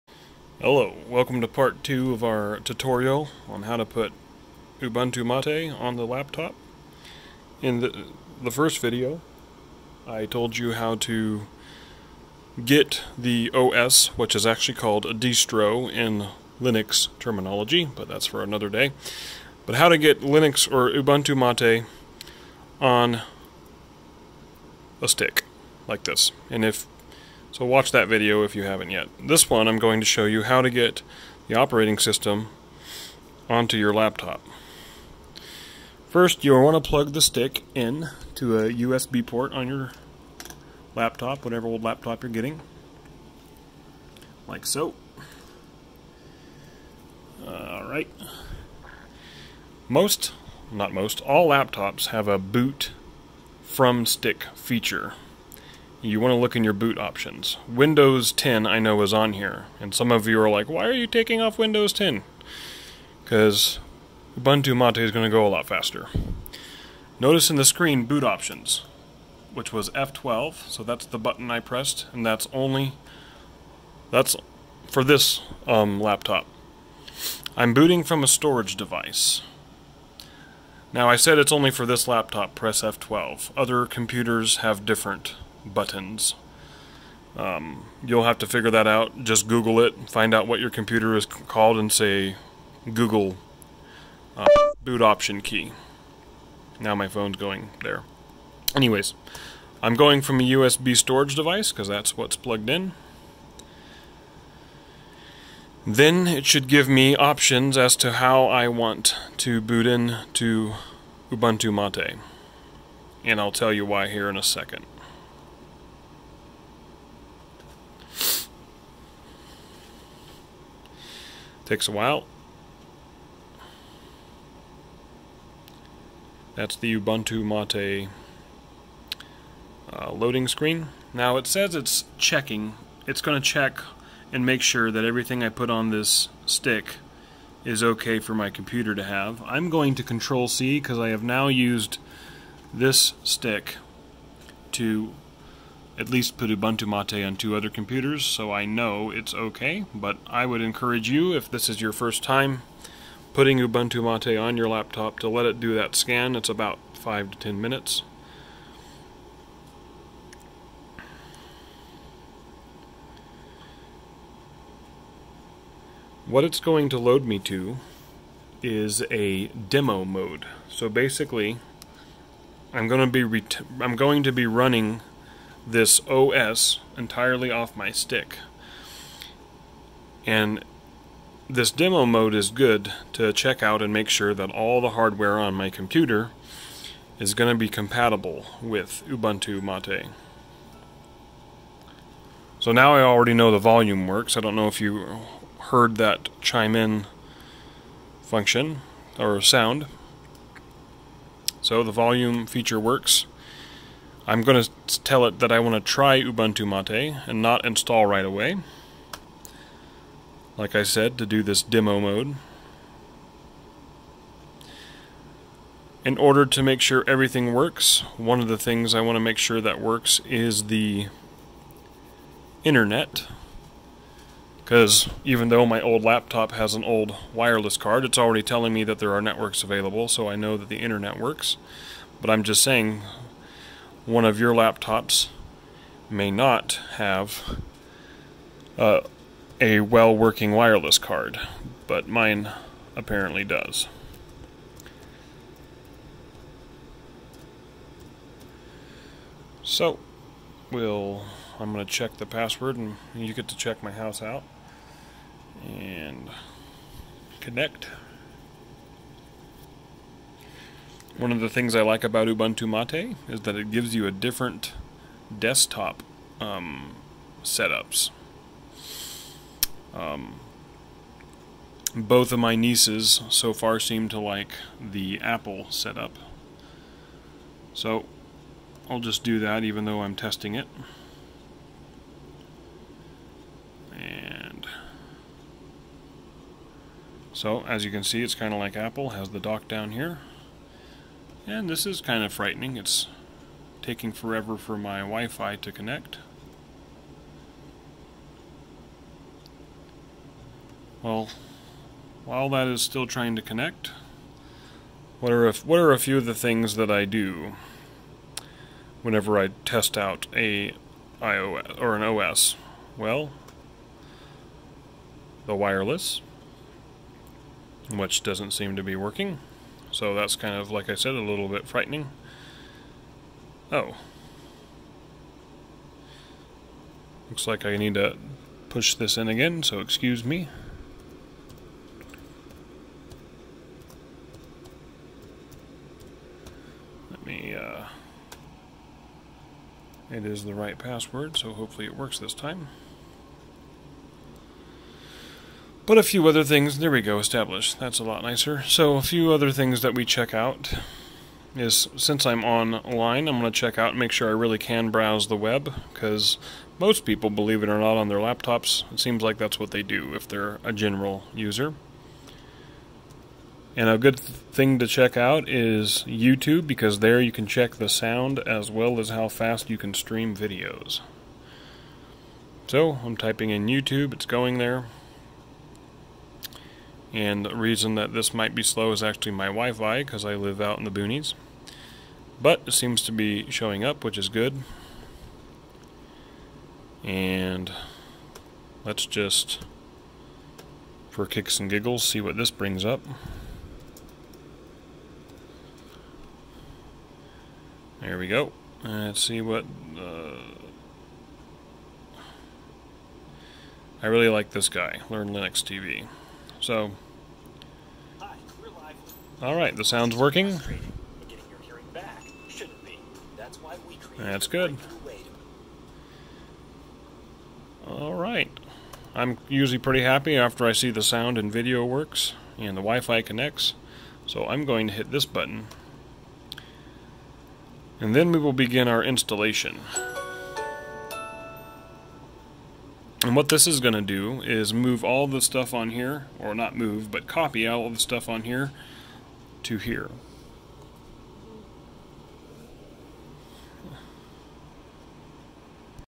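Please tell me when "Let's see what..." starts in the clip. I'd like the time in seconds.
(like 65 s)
398 s.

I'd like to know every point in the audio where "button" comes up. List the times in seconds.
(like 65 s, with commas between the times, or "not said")
71 s, 85 s, 425 s.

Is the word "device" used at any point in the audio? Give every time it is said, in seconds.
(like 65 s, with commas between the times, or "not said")
78 s, 101 s.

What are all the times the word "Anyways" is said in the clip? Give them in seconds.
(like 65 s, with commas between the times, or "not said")
98 s.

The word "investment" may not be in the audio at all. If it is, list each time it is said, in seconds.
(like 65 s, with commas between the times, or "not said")
not said.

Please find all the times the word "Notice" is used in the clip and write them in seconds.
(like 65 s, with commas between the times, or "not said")
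67 s.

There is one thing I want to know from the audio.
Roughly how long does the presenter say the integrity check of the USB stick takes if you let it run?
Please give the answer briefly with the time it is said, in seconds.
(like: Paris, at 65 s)
5 to 10 minutes, at 156 s.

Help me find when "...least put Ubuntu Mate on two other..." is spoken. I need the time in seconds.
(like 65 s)
146 s.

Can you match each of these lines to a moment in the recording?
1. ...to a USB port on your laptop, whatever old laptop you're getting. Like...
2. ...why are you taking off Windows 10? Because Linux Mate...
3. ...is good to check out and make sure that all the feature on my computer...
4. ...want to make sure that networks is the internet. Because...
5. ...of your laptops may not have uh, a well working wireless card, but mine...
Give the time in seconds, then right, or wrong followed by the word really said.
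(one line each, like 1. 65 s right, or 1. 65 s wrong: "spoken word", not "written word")
1. 38 s right
2. 60 s wrong: "Ubuntu", not "Linux"
3. 182 s wrong: "hardware", not "feature"
4. 219 s wrong: "works", not "networks"
5. 234 s right.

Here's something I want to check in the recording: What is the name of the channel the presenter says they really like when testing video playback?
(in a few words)
Learn Linux TV.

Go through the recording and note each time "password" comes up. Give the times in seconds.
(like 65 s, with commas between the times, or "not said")
252 s, 340 s.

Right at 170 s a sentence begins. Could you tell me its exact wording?
So basically, I'm going to be I'm going to be running this OS entirely off my stick.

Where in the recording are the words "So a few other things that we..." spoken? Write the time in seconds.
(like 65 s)
348 s.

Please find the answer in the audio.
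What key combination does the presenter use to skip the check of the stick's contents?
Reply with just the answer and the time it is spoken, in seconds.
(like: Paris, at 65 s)
control C, at 140 s.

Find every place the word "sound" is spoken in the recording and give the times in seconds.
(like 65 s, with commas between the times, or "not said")
199 s, 367 s, 409 s, 421 s.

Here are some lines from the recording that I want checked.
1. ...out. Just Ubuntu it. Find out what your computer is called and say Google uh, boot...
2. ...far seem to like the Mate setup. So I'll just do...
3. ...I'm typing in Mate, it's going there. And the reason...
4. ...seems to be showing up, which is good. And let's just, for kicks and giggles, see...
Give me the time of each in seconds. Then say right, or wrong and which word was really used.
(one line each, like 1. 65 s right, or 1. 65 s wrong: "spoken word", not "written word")
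1. 88 s wrong: "Google", not "Ubuntu"
2. 273 s wrong: "Apple", not "Mate"
3. 373 s wrong: "YouTube", not "Mate"
4. 382 s right.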